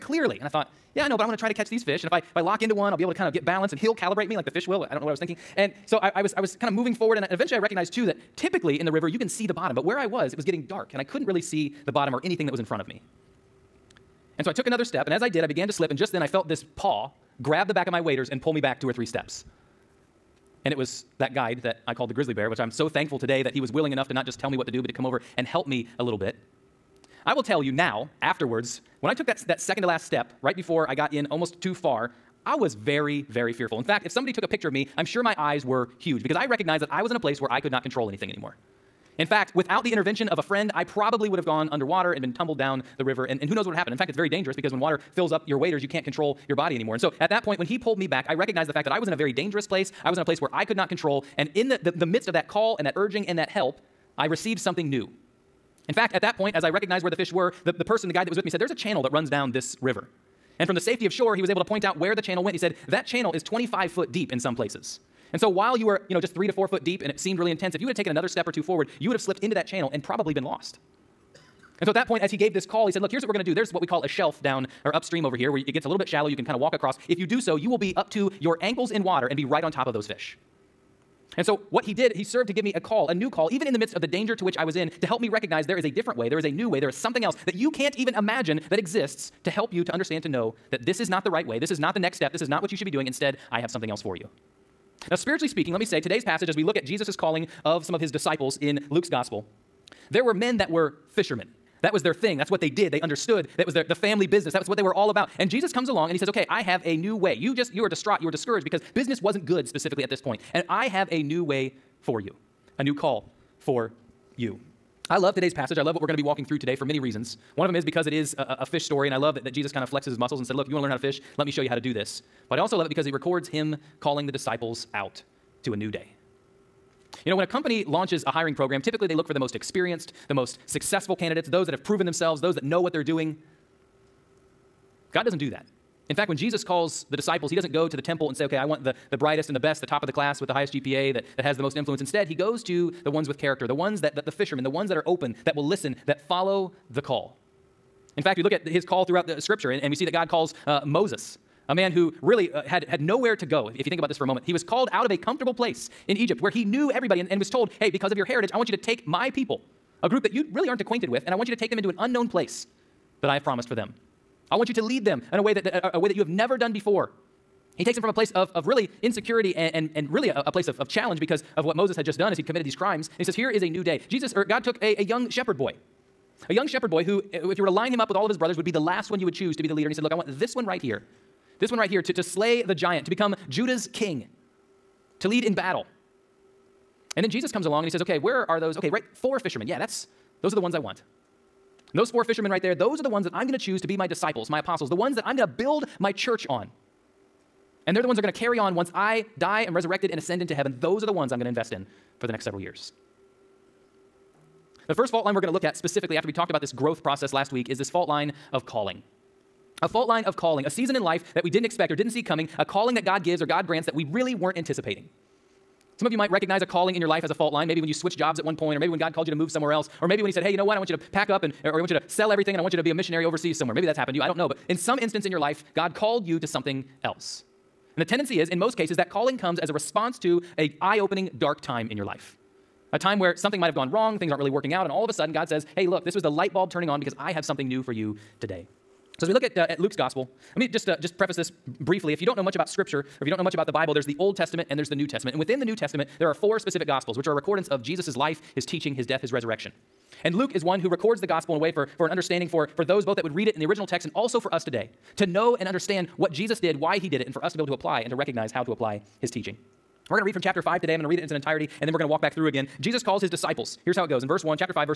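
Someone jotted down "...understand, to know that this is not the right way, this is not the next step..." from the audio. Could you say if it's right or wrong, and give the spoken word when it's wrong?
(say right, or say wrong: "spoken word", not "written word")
right.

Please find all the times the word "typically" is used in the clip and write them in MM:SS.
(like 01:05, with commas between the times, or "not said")
00:08, 02:08.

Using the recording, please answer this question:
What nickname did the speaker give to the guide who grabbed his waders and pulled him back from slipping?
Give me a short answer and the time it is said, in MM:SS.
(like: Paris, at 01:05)
the grizzly bear, at 00:22.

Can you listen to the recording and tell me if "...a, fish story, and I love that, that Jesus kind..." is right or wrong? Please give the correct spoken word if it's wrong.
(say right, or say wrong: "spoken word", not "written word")
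right.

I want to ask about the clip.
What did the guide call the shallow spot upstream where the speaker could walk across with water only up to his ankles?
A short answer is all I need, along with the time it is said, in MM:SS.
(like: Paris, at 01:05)
a shelf, at 01:14.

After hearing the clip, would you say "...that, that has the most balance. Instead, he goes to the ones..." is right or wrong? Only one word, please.
wrong.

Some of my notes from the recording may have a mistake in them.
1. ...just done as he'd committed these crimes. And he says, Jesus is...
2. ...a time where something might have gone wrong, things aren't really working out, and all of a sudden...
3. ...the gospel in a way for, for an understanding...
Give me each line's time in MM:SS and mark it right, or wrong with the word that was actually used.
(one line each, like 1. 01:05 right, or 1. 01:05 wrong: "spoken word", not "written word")
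1. 02:52 wrong: "Here", not "Jesus"
2. 03:52 right
3. 04:11 right.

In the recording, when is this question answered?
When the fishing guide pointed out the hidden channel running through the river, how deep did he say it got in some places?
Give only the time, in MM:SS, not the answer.
01:03.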